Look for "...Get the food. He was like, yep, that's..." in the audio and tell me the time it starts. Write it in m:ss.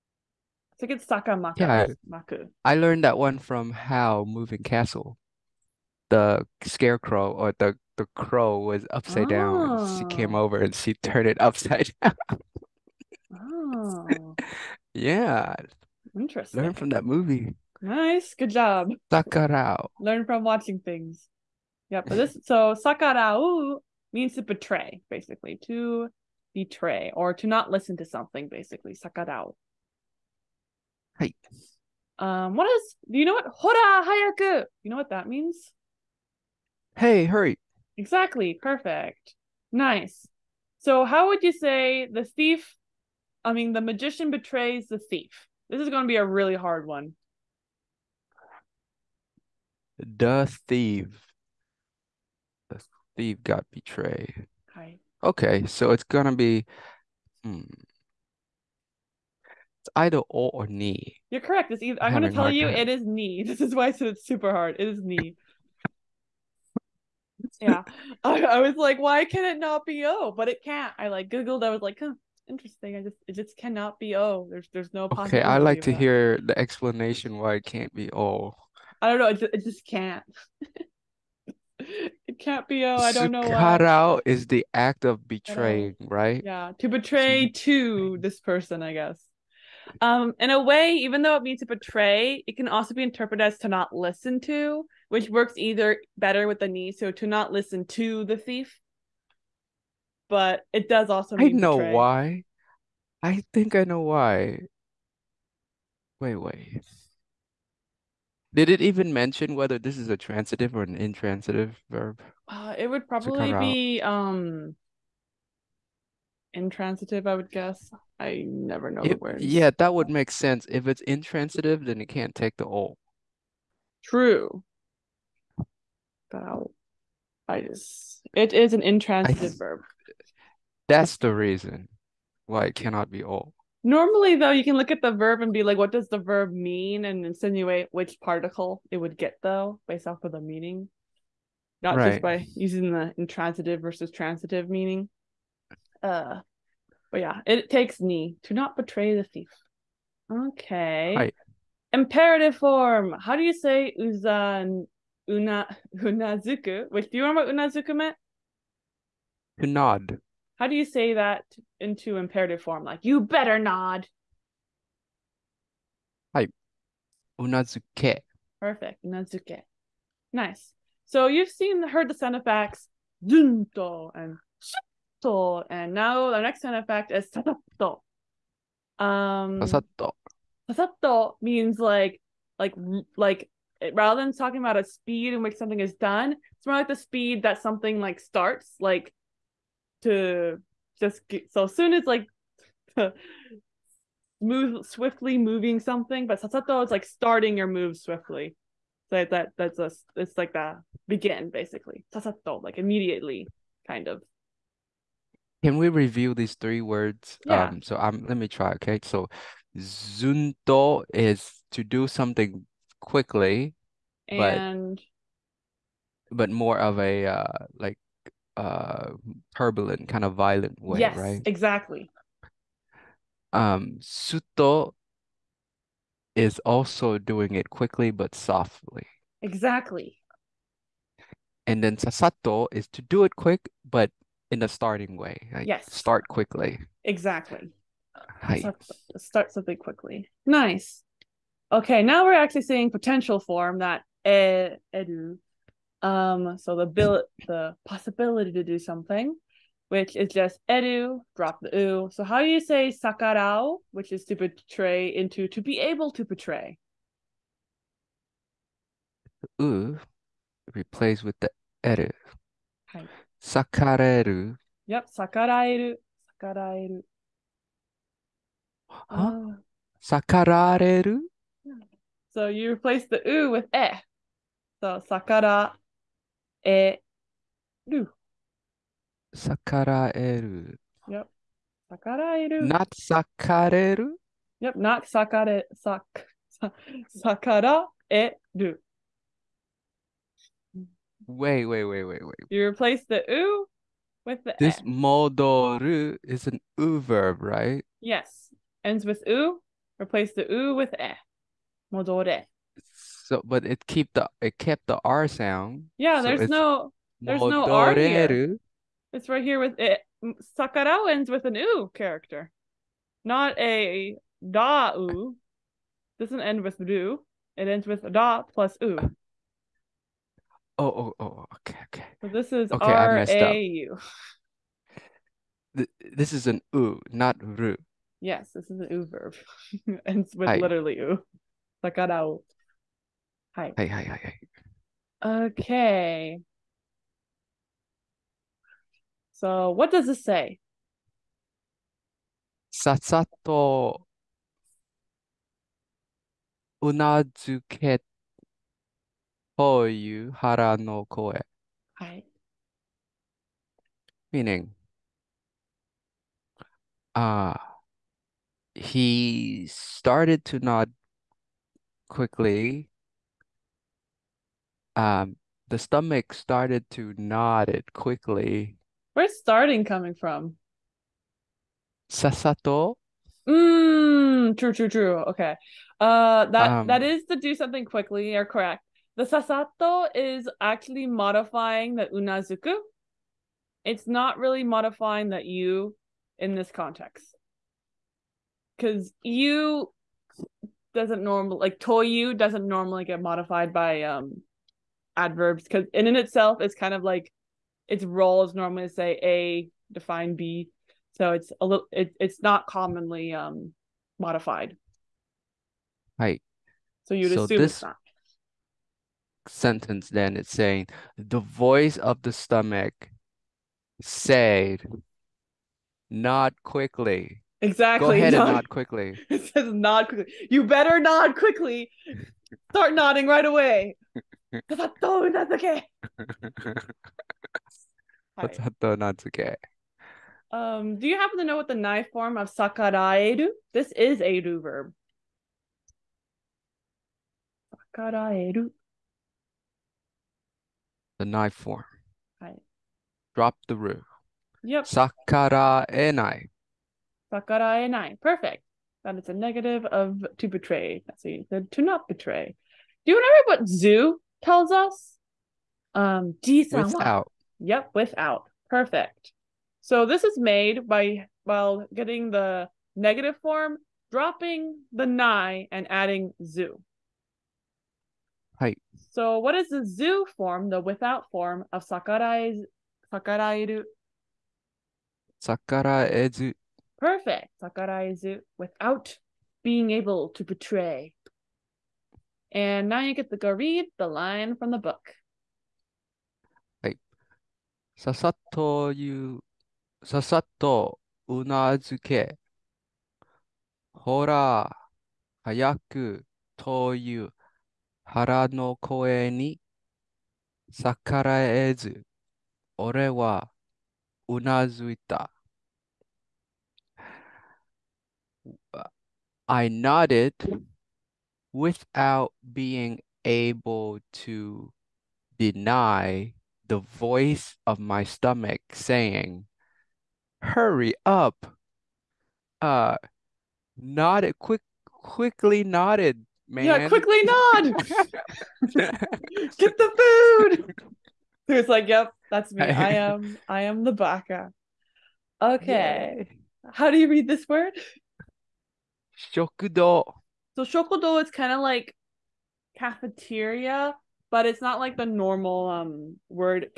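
8:48.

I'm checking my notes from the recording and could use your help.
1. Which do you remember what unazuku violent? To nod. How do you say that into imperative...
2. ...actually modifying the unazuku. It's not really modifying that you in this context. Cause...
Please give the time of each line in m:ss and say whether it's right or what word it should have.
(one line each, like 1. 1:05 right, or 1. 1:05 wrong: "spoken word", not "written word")
1. 2:36 wrong: "meant", not "violent"
2. 6:20 right.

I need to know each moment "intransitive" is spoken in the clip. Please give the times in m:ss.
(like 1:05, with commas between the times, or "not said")
1:50, 1:56, 2:01, 2:08, 2:23.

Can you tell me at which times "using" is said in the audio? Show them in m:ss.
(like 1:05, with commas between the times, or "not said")
2:22.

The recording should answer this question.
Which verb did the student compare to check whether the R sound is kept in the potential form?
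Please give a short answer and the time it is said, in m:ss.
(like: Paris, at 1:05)
modoru, at 4:54.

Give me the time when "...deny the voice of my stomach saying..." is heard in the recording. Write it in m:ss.
8:35.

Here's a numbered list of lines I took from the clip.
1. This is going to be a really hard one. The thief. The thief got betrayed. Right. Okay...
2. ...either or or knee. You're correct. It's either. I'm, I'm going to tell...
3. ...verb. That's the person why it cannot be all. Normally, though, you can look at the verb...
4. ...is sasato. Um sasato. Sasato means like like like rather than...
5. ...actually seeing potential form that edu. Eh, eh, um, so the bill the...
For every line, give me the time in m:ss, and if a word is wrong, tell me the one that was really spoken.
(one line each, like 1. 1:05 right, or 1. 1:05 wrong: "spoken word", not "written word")
1. 0:45 right
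2. 0:59 right
3. 2:09 wrong: "reason", not "person"
4. 2:57 right
5. 4:02 right.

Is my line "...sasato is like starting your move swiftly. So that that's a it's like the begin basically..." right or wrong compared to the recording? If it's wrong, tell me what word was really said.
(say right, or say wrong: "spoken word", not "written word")
right.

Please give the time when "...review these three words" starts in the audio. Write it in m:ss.
3:25.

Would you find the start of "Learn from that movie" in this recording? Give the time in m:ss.
0:16.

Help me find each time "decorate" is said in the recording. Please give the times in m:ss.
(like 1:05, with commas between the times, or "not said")
not said.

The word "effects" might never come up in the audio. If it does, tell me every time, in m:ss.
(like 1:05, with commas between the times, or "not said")
2:52, 2:56.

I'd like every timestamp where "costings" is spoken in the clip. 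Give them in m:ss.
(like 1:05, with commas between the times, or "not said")
not said.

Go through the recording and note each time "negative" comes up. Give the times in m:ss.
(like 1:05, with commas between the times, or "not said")
7:29, 7:42.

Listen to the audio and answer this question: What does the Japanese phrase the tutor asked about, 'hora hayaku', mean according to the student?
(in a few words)
hey, hurry.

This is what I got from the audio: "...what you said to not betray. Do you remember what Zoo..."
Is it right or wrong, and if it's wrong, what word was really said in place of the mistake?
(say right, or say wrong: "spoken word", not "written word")
right.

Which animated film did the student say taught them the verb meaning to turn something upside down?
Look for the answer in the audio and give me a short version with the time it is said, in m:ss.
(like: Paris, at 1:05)
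Howl's Moving Castle, at 0:03.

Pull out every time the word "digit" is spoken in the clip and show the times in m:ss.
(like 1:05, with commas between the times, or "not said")
not said.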